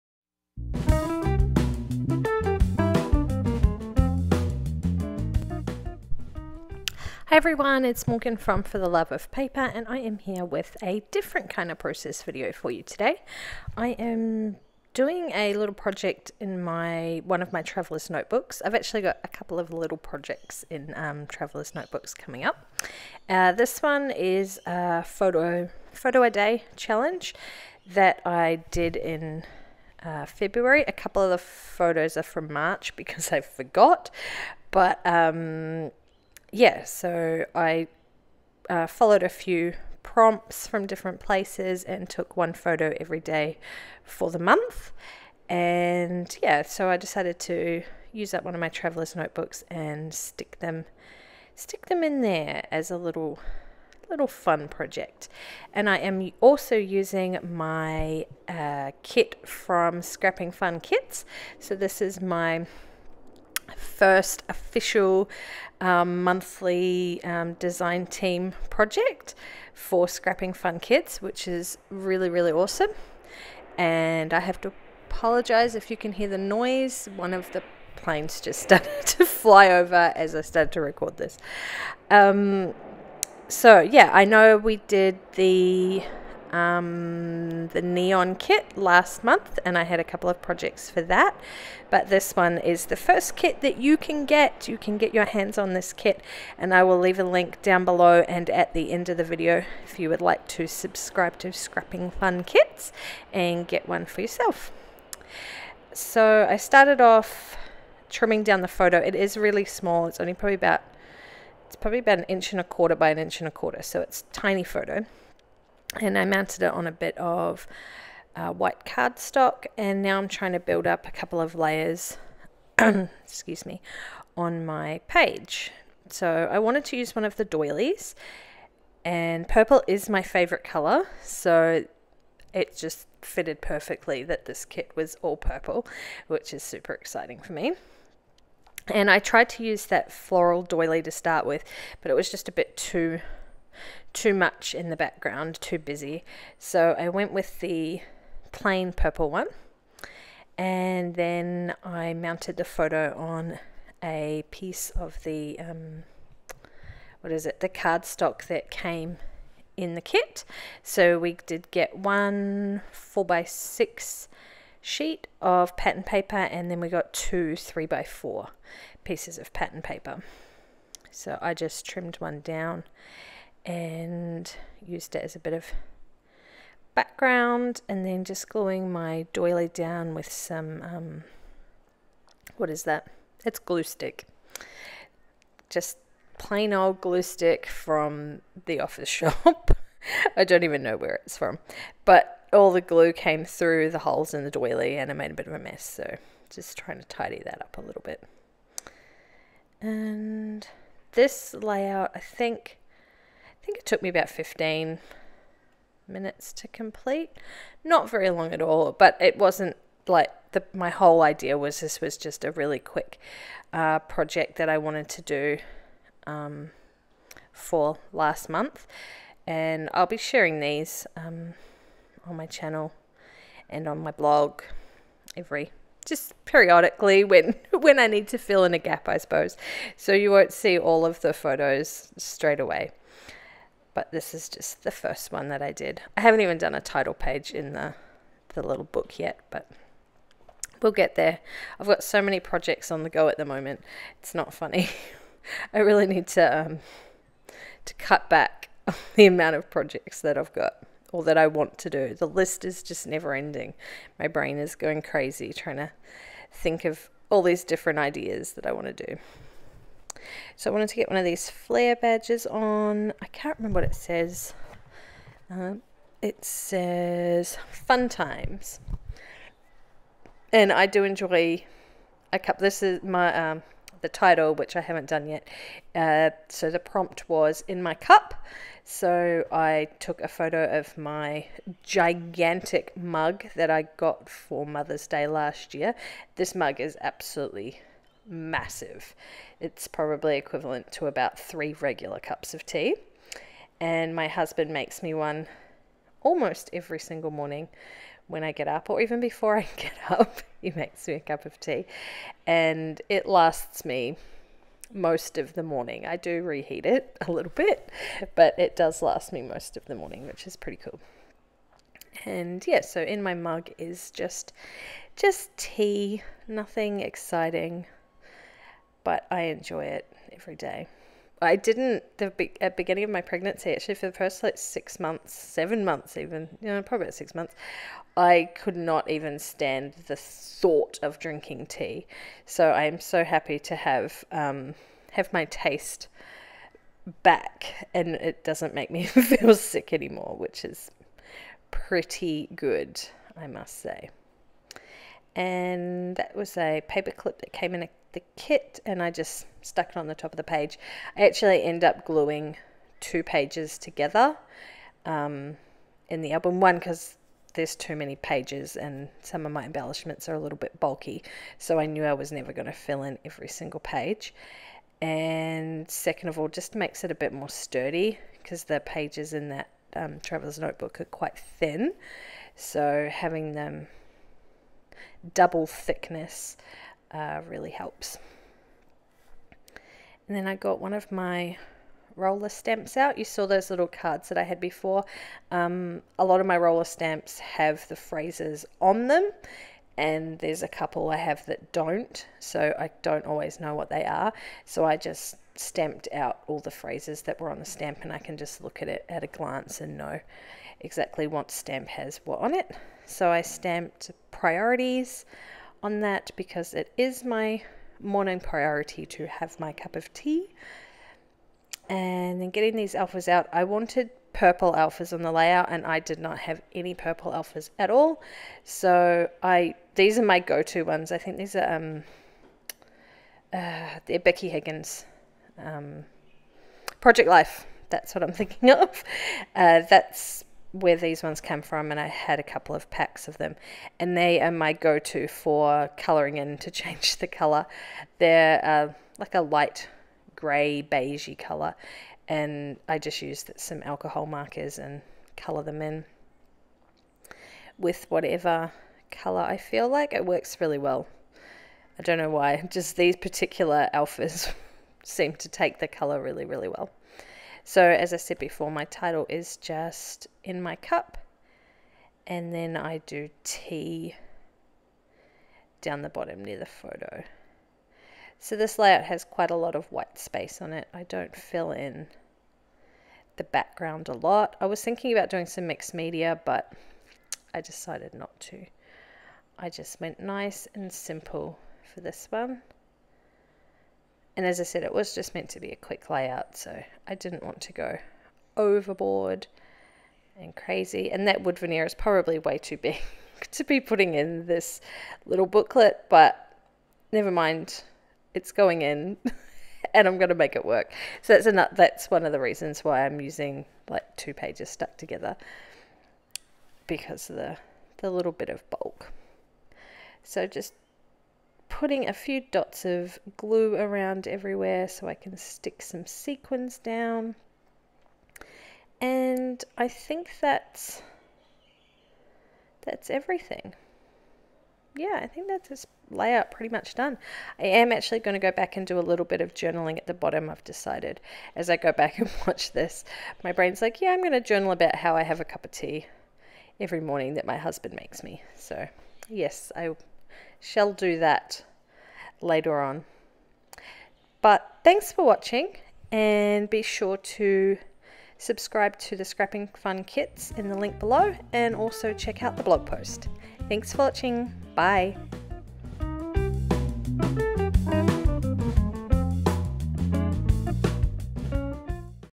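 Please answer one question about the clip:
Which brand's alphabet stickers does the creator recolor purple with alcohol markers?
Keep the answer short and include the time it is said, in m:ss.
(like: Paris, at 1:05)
Becky Higgins, at 7:04.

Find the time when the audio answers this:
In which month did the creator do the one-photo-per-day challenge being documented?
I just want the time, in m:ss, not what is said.
0:30.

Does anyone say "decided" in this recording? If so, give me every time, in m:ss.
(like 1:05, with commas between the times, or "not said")
0:46, 7:57, 8:50.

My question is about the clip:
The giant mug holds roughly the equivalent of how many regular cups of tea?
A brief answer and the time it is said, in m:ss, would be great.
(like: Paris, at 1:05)
3, at 4:51.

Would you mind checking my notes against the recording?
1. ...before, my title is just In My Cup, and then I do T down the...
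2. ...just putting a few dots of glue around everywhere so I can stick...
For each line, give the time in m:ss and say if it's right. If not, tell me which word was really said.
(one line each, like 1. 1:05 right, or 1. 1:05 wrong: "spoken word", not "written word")
1. 7:38 right
2. 8:30 right.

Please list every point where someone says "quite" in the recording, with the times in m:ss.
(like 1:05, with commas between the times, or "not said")
6:11, 7:49.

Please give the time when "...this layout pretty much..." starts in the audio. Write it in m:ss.
8:45.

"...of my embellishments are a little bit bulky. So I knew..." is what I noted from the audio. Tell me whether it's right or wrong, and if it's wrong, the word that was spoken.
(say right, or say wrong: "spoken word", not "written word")
right.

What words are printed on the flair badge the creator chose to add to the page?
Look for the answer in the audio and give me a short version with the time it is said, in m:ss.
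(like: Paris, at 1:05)
fun times, at 4:27.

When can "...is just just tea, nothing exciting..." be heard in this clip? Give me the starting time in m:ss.
5:13.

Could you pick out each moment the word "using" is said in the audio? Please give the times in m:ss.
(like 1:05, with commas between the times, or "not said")
0:56, 8:23.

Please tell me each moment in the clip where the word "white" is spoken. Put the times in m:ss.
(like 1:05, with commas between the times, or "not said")
1:58, 7:49.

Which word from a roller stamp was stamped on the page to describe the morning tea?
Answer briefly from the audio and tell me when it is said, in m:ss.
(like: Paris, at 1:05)
priorities, at 6:44.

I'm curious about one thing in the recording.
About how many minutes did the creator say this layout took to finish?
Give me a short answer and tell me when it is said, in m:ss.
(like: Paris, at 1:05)
15, at 3:24.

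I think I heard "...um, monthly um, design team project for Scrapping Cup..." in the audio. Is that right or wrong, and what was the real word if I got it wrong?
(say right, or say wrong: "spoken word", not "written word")
wrong: "Fun", not "Cup".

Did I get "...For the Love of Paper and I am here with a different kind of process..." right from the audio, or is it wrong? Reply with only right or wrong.
right.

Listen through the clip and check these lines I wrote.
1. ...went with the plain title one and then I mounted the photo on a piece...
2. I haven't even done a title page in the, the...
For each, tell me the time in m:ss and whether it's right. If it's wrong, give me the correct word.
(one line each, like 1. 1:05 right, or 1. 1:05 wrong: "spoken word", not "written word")
1. 2:27 wrong: "purple", not "title"
2. 3:56 right.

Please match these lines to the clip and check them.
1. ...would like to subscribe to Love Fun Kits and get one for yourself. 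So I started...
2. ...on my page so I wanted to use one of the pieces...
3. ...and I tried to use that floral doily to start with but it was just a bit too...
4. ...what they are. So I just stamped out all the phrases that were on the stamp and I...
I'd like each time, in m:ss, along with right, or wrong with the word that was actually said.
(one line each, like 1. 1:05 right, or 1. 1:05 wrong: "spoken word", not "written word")
1. 1:40 wrong: "Scrapping", not "Love"
2. 2:04 wrong: "doilies", not "pieces"
3. 2:18 right
4. 6:33 right.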